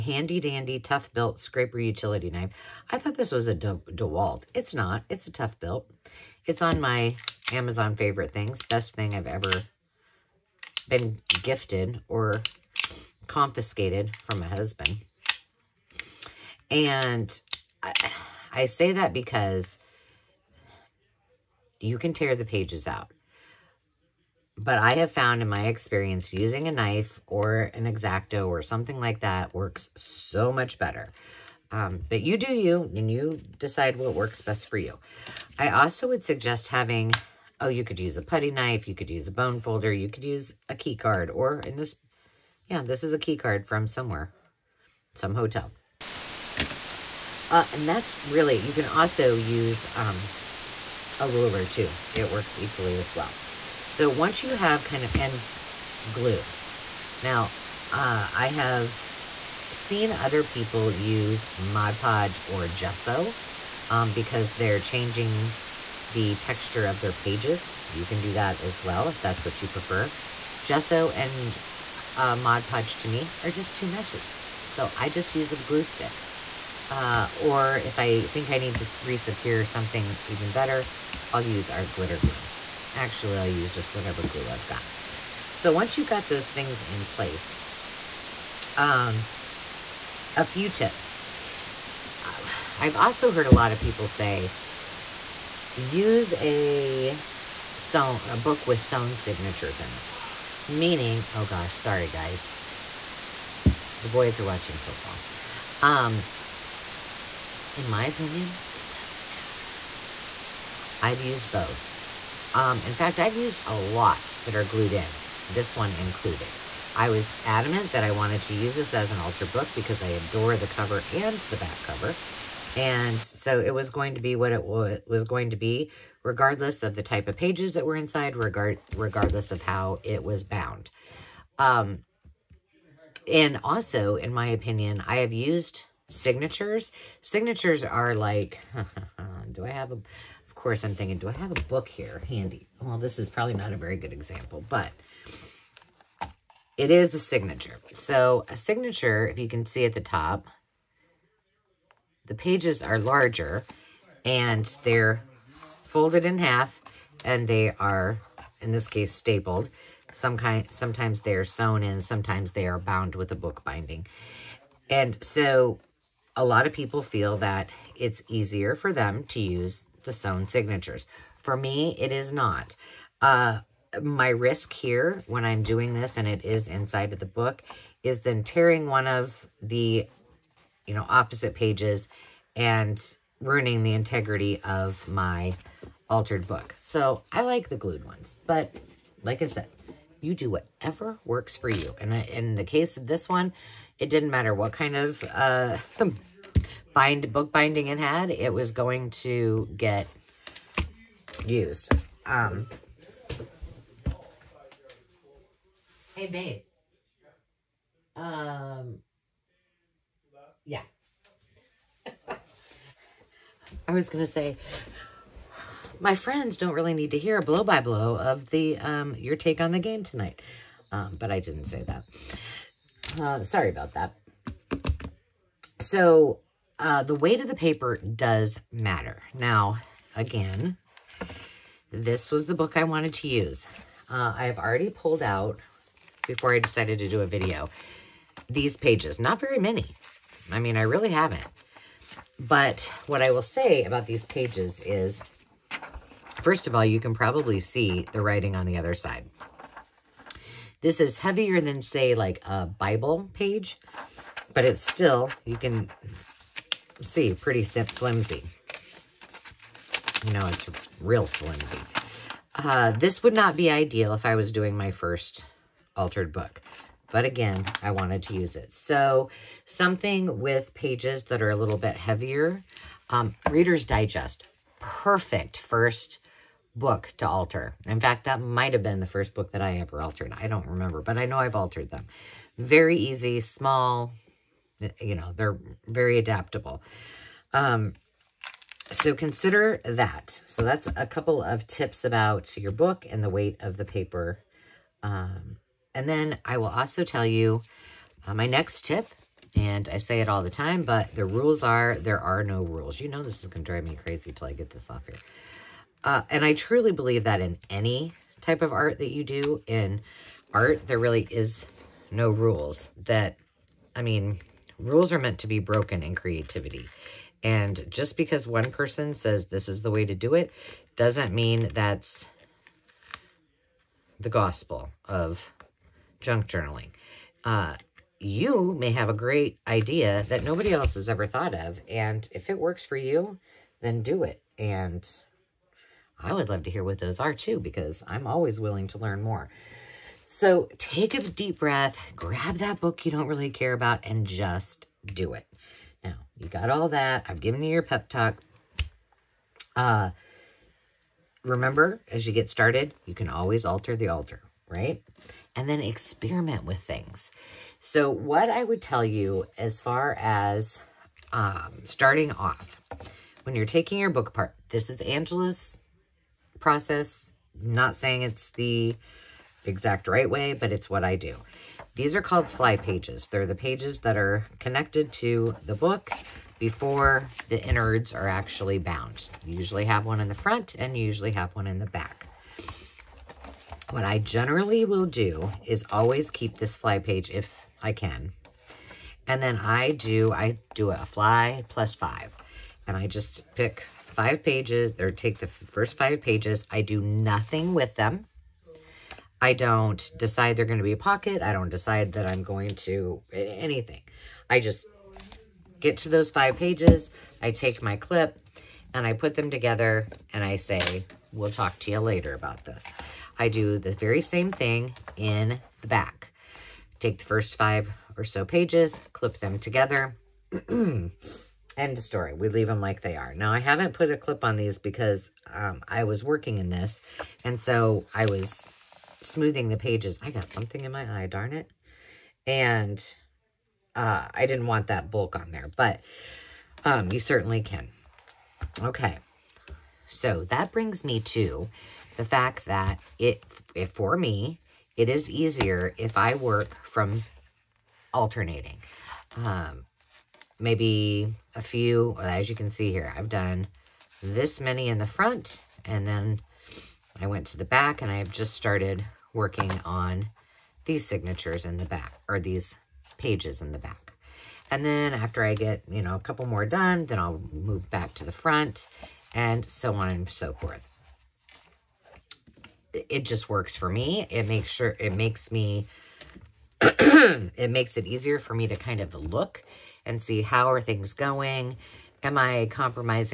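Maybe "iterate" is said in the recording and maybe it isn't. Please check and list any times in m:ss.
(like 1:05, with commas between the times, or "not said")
not said.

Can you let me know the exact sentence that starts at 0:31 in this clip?
Um, but you do you, and you decide what works best for you.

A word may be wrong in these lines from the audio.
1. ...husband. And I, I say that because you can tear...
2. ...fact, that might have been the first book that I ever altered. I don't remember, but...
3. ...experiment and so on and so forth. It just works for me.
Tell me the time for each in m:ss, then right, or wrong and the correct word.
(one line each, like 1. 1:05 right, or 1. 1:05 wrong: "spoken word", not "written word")
1. 0:14 right
2. 4:38 right
3. 7:48 wrong: "front", not "experiment".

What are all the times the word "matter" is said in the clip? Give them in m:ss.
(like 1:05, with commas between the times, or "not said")
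1:49, 3:14, 3:48.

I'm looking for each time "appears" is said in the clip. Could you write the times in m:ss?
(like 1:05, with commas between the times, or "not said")
not said.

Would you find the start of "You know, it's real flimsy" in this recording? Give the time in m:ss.
4:20.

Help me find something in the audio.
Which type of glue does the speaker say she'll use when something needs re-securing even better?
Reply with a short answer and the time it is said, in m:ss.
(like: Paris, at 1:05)
glitter glue, at 1:21.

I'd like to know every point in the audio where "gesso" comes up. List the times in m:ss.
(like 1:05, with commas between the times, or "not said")
1:02, 1:10.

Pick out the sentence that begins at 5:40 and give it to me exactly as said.
So take a deep breath, grab that book you don't really care about, and just do it.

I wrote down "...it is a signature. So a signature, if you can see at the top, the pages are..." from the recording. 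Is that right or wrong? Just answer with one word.
right.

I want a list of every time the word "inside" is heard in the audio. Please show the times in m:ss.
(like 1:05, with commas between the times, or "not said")
2:07, 2:56.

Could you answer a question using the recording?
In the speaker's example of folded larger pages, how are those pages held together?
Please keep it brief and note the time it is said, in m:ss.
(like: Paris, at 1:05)
stapled, at 2:39.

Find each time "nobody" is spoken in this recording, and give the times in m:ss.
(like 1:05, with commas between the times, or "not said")
5:30.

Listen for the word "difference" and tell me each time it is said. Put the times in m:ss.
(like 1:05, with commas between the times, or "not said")
not said.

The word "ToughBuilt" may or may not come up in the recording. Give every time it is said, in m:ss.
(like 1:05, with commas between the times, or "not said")
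0:00, 0:05.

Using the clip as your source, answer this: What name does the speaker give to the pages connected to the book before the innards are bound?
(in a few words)
fly pages.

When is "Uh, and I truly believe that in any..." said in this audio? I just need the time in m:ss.
5:06.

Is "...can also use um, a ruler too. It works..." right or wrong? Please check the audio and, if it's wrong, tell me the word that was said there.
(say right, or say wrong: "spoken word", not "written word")
right.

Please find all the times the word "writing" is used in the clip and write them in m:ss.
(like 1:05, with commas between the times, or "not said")
4:08.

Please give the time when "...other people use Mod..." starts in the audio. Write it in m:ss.
1:00.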